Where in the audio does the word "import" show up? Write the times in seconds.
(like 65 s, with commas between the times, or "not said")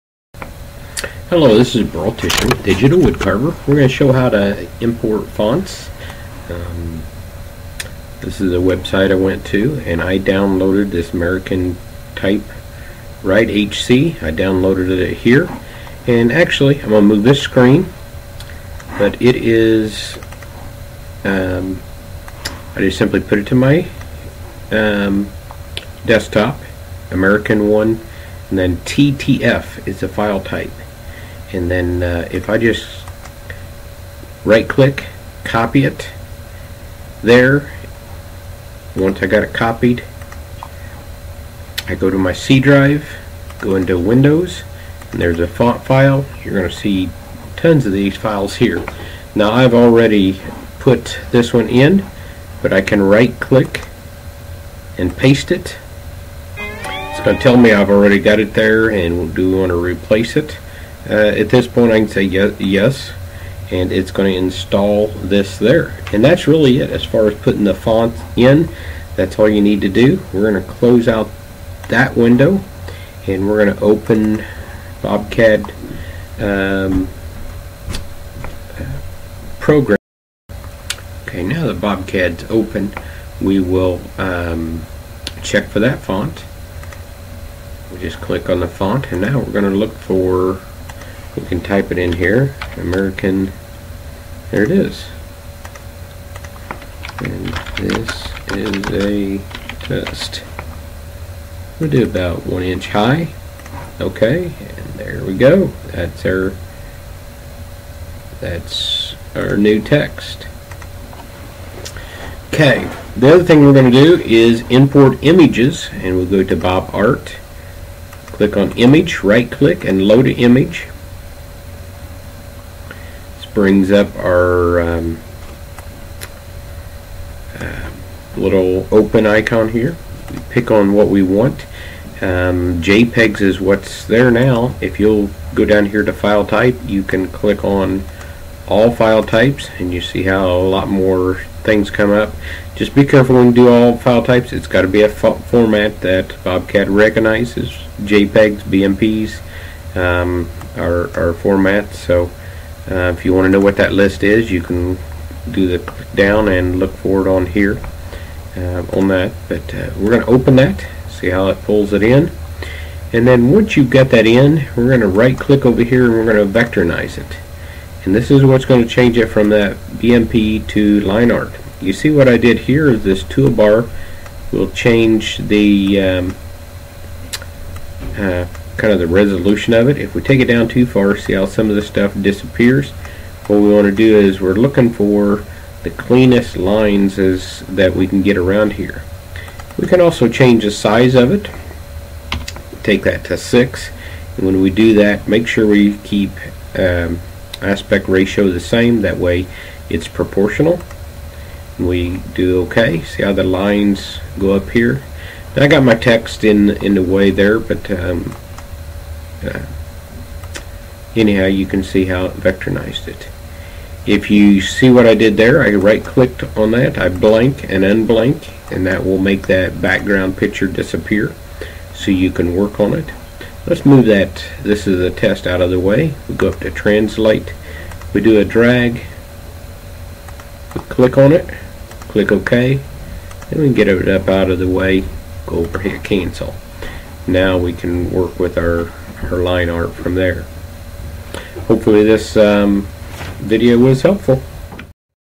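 4 s, 114 s.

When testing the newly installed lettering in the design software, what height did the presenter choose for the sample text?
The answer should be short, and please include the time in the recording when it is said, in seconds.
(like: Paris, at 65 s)
1 inch, at 102 s.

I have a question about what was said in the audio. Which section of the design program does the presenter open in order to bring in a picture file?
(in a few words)
BobART.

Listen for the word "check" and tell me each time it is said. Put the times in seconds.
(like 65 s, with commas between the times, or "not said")
85 s.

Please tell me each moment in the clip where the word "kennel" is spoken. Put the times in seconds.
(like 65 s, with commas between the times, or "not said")
not said.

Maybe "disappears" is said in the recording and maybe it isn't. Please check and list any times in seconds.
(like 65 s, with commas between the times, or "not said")
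182 s, 220 s.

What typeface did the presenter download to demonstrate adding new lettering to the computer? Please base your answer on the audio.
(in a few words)
American Type Right HC.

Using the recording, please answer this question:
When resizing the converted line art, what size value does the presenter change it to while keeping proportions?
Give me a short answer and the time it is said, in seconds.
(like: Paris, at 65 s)
6, at 192 s.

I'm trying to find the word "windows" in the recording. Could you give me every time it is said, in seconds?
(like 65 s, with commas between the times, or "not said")
43 s, 72 s.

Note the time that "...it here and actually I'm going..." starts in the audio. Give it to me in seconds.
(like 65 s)
14 s.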